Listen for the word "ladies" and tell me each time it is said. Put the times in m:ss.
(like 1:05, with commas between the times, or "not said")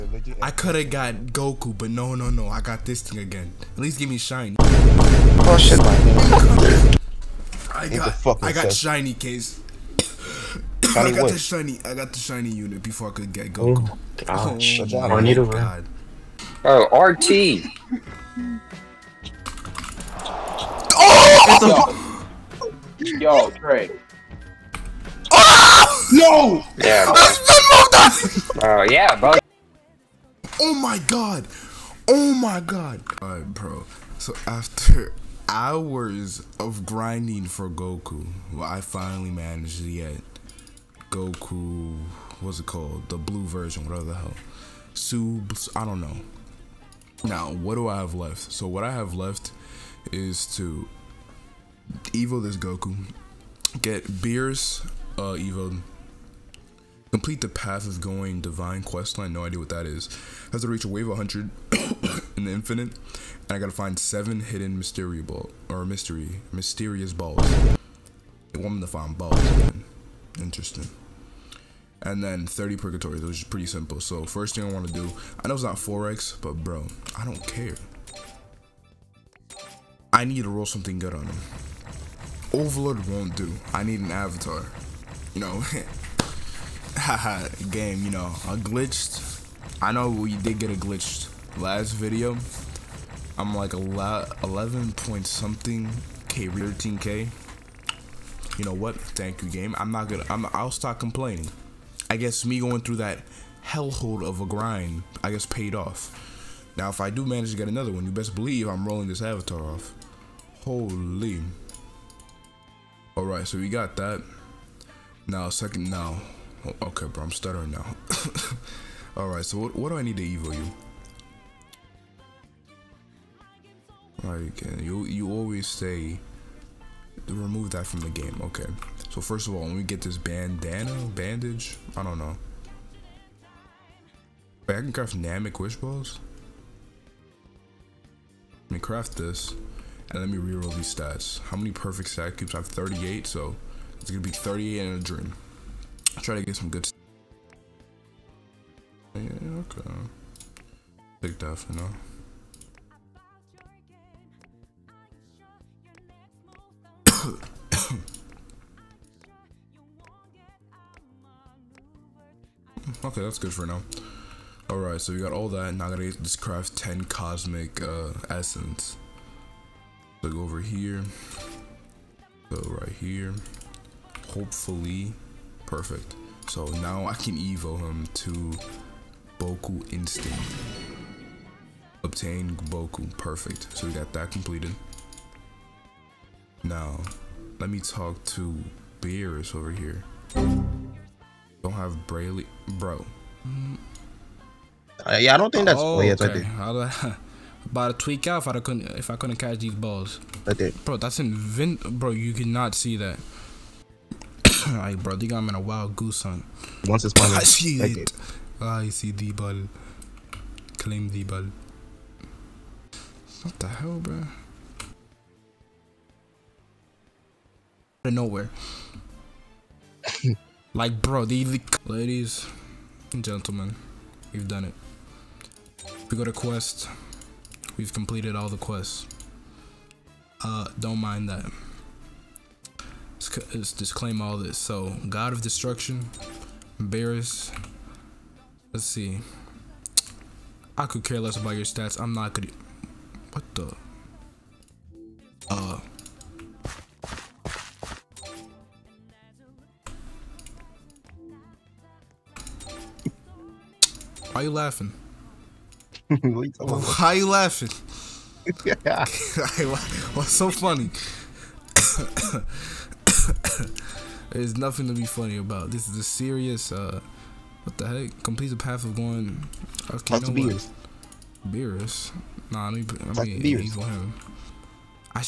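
3:41.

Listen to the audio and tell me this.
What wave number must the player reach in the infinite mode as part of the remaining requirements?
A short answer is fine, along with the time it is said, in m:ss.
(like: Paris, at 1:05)
100, at 1:00.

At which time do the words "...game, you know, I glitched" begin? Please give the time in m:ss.
1:27.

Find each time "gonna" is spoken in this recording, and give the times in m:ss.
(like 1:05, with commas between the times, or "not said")
1:40, 2:24.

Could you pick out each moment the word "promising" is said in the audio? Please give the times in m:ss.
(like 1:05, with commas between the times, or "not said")
not said.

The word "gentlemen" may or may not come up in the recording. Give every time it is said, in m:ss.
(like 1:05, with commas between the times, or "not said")
3:43.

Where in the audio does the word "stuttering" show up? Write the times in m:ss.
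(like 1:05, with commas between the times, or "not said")
1:57.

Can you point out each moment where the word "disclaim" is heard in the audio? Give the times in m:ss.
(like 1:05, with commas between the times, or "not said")
3:53.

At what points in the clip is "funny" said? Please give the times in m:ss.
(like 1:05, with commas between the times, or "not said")
4:20, 4:25.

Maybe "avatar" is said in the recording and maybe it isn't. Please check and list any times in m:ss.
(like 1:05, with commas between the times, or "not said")
1:24, 1:49.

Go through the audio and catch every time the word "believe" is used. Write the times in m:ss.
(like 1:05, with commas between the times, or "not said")
1:48.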